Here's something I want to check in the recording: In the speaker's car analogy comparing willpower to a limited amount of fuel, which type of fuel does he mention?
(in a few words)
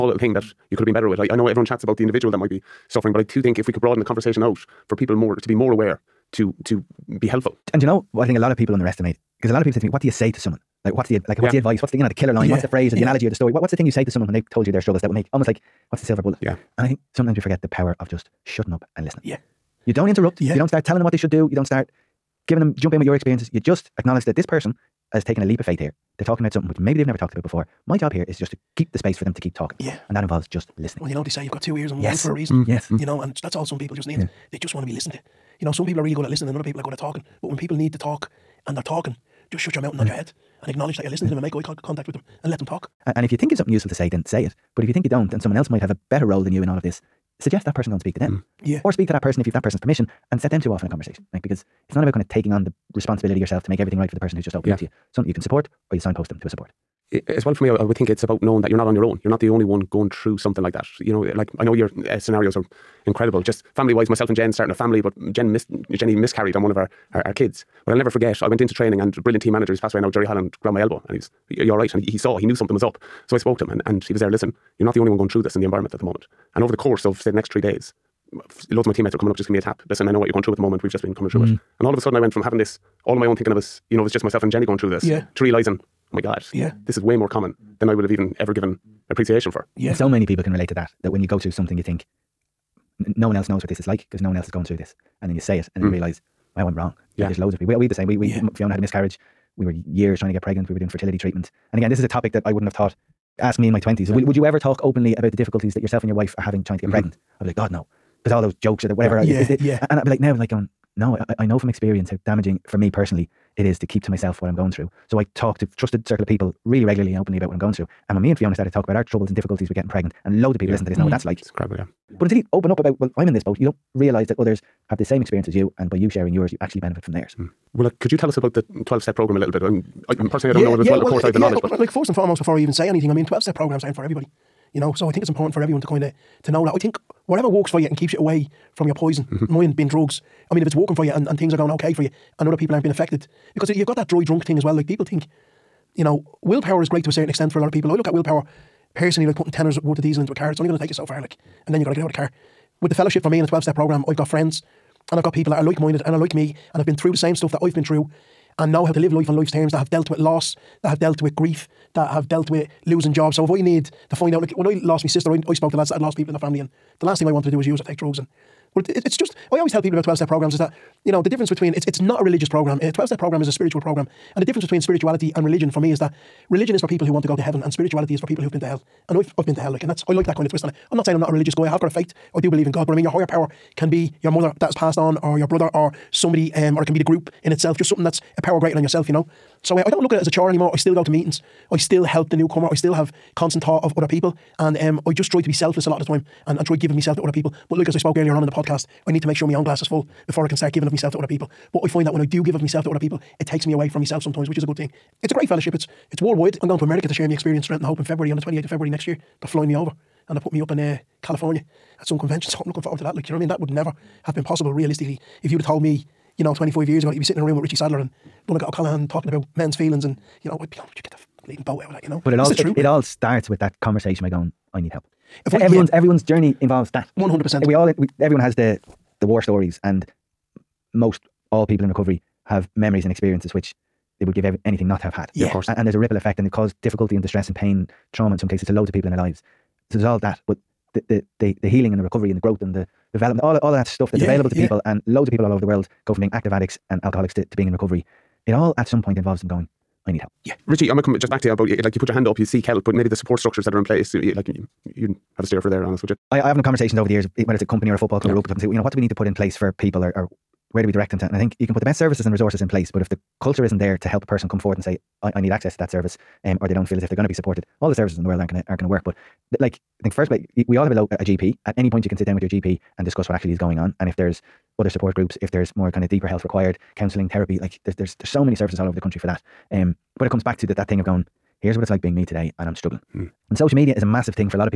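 Diesel.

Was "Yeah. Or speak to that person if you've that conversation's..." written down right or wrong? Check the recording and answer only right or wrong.
wrong.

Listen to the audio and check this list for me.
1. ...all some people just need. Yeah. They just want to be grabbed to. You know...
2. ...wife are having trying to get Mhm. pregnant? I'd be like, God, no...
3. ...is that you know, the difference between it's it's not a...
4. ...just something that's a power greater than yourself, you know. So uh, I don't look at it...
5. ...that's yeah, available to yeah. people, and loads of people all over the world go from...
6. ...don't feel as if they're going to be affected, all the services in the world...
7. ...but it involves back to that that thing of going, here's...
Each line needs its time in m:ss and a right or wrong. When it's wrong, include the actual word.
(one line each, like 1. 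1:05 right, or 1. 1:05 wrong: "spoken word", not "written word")
1. 0:33 wrong: "listened", not "grabbed"
2. 1:46 right
3. 2:50 right
4. 3:07 right
5. 4:04 right
6. 4:26 wrong: "supported", not "affected"
7. 4:40 wrong: "comes", not "involves".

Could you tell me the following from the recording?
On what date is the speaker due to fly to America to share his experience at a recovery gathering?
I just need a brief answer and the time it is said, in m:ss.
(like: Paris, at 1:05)
28 February, at 3:28.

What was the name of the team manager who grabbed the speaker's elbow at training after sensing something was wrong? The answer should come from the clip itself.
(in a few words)
Jerry Holland.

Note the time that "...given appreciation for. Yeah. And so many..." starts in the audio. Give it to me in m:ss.
1:28.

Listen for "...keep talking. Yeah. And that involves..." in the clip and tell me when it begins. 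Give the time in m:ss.
0:29.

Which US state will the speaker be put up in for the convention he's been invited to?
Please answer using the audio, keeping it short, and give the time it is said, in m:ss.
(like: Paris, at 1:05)
California, at 3:31.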